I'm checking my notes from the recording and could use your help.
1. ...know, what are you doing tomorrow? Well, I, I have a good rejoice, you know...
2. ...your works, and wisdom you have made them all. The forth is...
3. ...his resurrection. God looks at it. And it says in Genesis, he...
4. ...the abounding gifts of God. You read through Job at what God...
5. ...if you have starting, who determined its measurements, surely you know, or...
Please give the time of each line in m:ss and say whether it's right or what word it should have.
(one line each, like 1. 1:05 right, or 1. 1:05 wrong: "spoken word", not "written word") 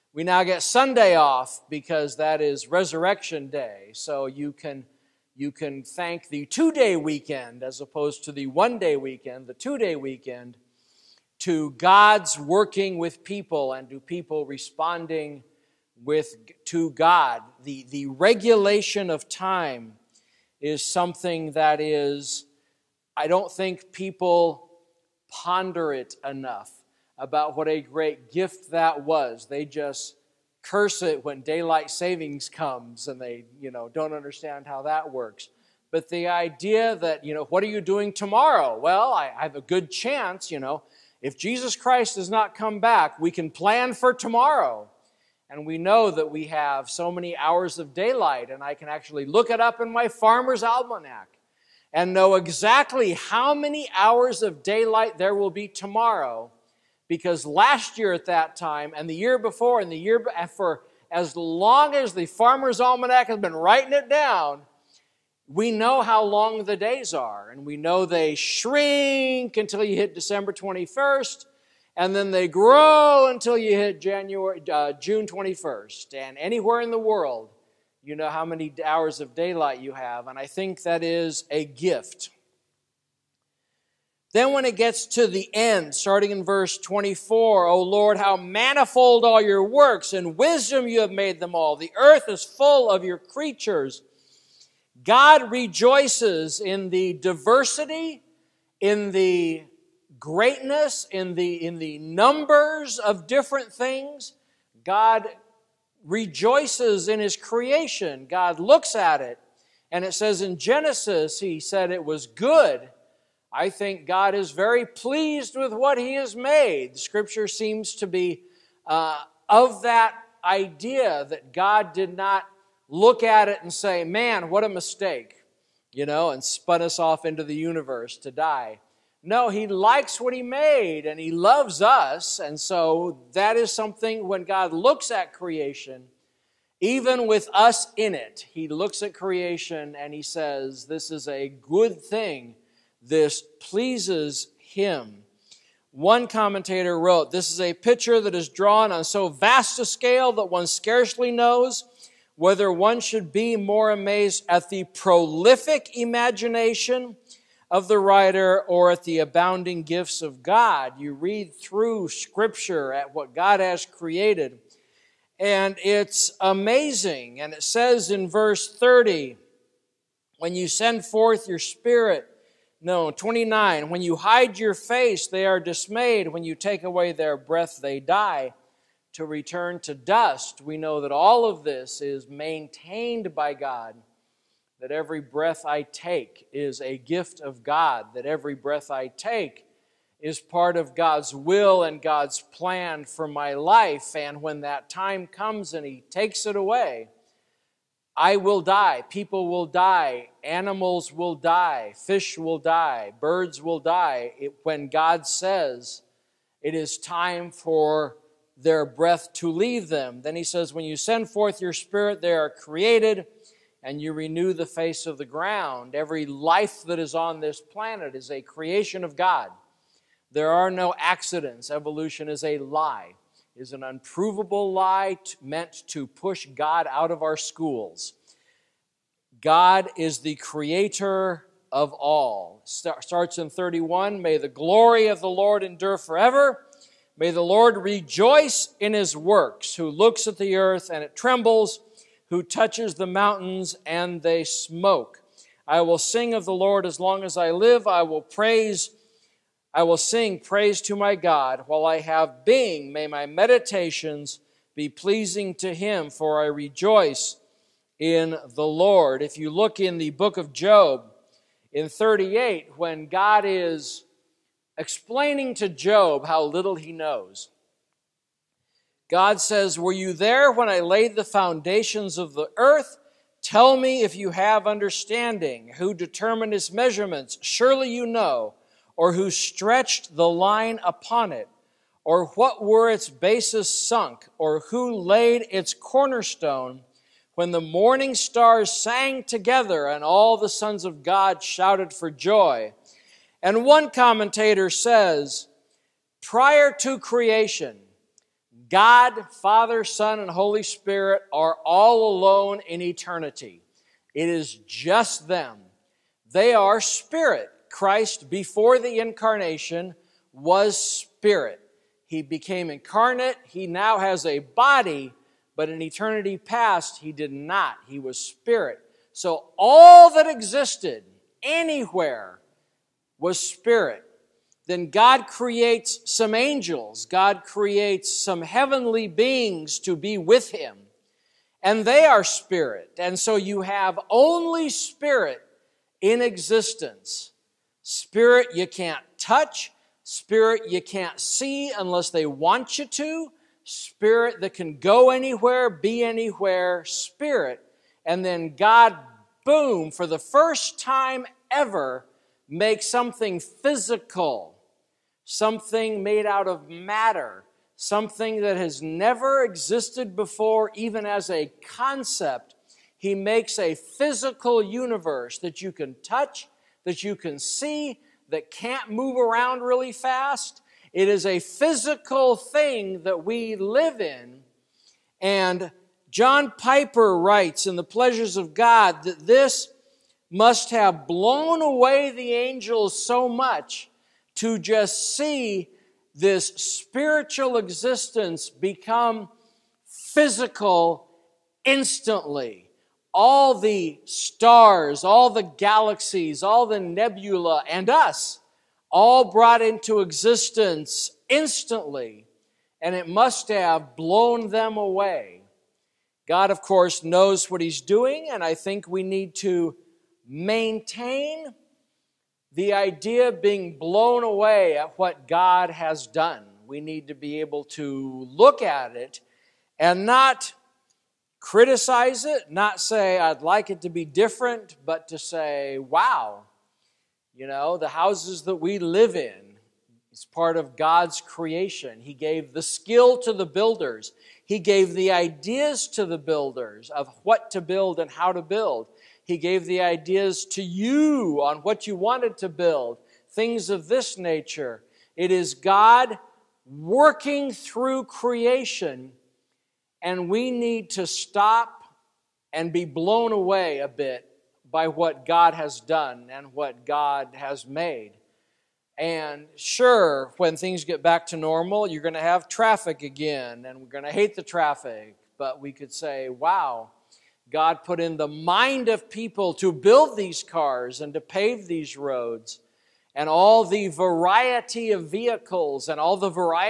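1. 0:37 wrong: "chance", not "rejoice"
2. 1:29 wrong: "earth", not "forth"
3. 1:47 wrong: "creation", not "resurrection"
4. 2:39 wrong: "Scripture", not "Job"
5. 4:34 wrong: "understanding", not "starting".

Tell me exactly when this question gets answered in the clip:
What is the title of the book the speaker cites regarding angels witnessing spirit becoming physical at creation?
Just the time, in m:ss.
6:17.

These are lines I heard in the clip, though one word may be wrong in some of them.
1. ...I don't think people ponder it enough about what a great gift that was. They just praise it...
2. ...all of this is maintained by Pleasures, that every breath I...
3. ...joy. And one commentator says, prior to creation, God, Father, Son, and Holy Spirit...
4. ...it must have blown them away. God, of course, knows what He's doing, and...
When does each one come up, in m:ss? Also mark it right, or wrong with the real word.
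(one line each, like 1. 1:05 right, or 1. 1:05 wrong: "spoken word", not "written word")
1. 0:23 wrong: "curse", not "praise"
2. 3:01 wrong: "God", not "Pleasures"
3. 4:52 right
4. 6:42 right.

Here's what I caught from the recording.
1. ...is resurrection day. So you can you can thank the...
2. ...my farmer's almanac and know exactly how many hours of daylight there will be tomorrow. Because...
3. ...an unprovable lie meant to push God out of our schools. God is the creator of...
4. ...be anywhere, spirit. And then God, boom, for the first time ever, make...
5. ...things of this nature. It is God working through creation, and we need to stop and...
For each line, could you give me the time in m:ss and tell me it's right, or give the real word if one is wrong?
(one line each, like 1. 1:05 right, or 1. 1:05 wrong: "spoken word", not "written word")
1. 0:02 right
2. 0:49 right
3. 3:43 right
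4. 5:45 right
5. 7:23 right.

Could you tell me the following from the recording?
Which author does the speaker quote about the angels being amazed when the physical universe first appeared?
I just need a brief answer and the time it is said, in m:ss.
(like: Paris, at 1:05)
John Piper, at 6:16.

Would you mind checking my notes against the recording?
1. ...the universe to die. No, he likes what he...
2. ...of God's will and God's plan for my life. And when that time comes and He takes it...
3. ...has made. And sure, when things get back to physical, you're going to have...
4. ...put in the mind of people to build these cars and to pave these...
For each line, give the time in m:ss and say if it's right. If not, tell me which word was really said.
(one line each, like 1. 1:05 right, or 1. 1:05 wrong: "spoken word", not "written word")
1. 2:07 right
2. 3:10 right
3. 7:37 wrong: "normal", not "physical"
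4. 7:47 right.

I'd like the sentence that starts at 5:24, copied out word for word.
Then God creates some angels, God creates some heavenly beings to be with him, and they are spirit.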